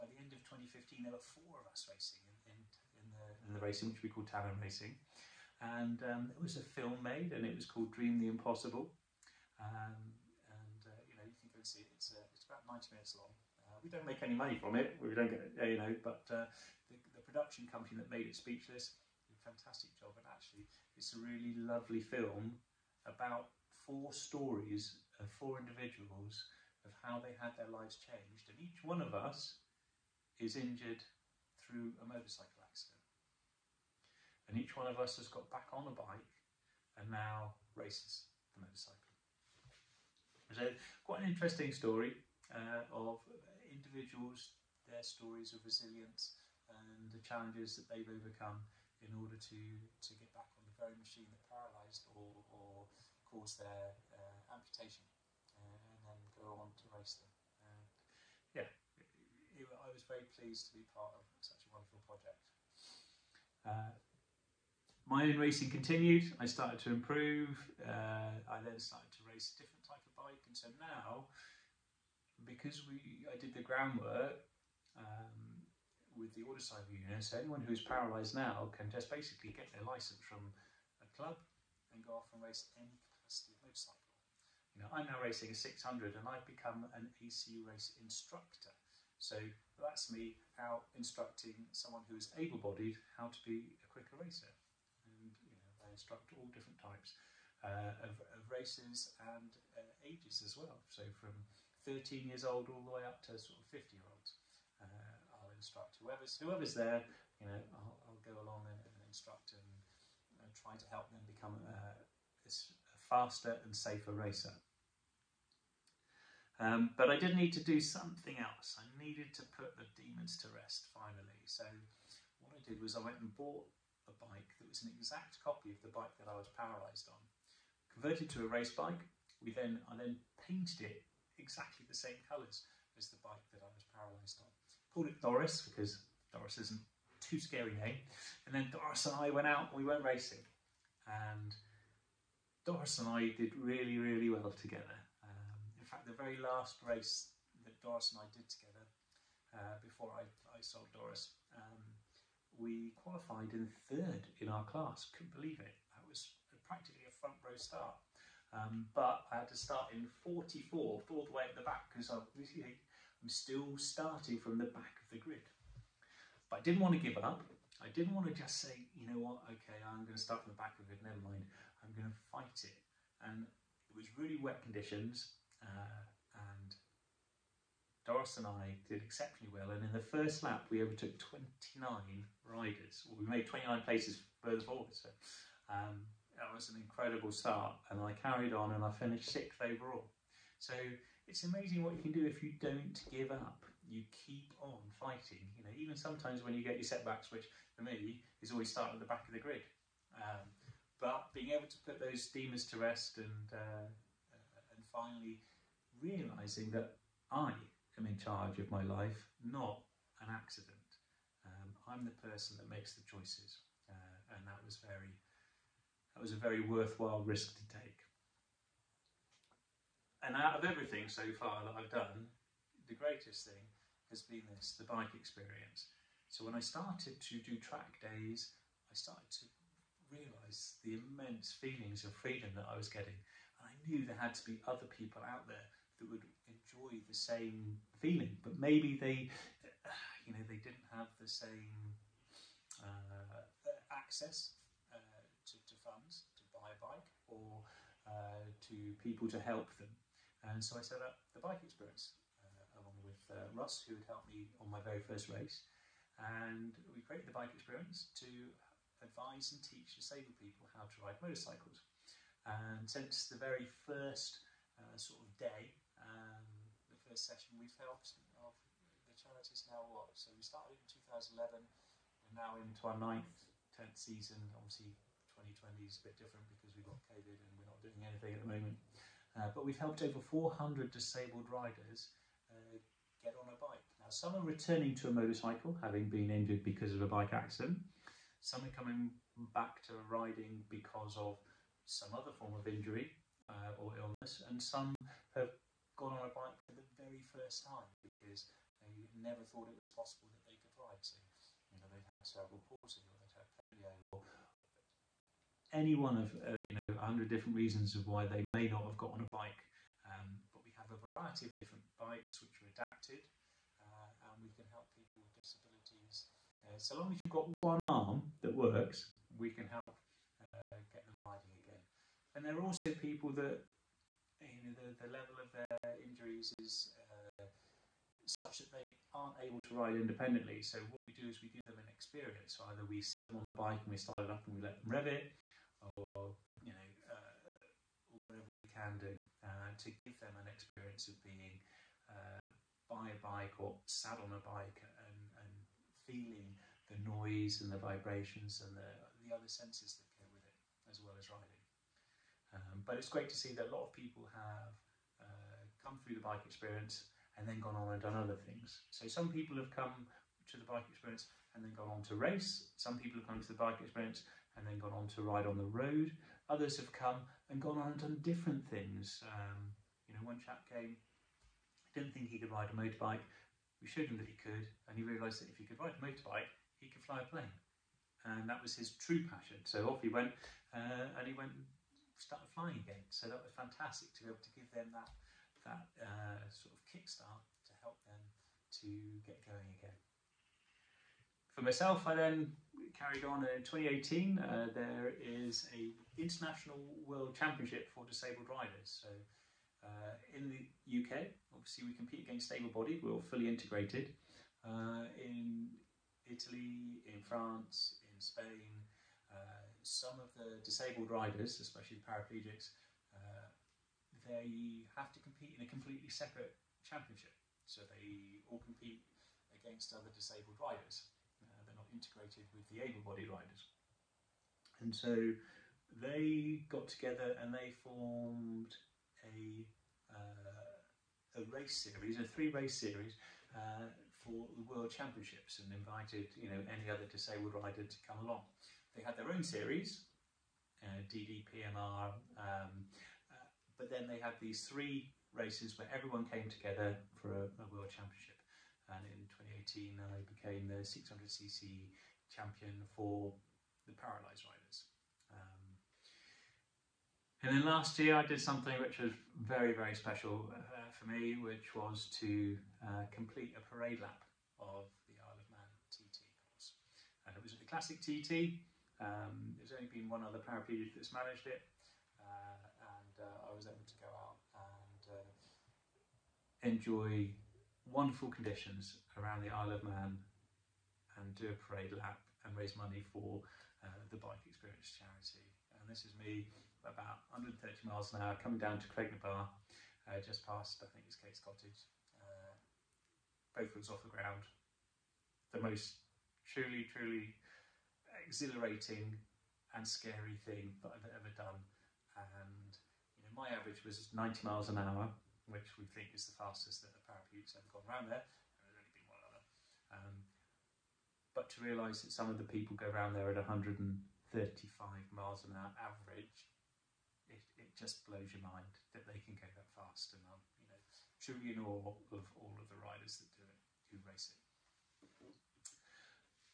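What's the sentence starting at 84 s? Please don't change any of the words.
You know, I'm now racing a 600 and I've become an ACU race instructor.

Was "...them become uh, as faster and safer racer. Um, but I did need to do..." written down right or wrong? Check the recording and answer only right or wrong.
right.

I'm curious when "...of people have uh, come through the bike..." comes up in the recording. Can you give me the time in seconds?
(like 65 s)
353 s.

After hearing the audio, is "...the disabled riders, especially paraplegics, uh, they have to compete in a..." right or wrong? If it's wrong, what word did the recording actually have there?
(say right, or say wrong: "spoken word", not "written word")
right.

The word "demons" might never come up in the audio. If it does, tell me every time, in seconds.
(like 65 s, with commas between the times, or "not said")
119 s, 202 s.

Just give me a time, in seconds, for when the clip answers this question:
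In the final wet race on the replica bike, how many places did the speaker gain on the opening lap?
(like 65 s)
180 s.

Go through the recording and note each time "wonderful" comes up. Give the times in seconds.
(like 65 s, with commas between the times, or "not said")
61 s, 477 s.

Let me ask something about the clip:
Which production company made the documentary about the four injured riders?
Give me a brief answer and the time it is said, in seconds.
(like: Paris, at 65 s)
Speechless, at 18 s.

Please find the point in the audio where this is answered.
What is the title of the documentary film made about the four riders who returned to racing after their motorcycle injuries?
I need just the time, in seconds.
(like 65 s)
7 s.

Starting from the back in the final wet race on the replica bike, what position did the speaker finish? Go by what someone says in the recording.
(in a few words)
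6th.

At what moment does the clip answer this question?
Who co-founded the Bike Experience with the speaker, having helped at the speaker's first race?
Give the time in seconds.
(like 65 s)
253 s.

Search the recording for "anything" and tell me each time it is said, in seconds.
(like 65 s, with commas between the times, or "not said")
278 s.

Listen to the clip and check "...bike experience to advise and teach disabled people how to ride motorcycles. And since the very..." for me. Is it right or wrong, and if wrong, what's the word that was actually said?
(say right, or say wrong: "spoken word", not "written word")
right.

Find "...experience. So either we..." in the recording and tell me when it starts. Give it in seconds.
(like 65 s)
331 s.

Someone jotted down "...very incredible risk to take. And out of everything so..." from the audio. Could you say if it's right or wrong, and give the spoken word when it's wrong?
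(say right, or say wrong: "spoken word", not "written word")
wrong: "worthwhile", not "incredible".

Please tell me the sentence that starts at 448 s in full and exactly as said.
And in 2018, I became the 600cc champion for the Paralyzed Rider.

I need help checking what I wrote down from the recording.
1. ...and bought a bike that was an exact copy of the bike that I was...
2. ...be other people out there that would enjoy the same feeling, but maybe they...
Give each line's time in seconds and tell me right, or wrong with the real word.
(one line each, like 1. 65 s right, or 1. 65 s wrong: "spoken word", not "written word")
1. 123 s right
2. 234 s right.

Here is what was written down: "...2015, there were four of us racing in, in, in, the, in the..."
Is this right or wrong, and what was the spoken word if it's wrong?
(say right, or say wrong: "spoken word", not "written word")
right.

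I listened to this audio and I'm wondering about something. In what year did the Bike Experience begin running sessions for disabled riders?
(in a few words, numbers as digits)
2011.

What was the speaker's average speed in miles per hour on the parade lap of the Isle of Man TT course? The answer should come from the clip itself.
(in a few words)
90.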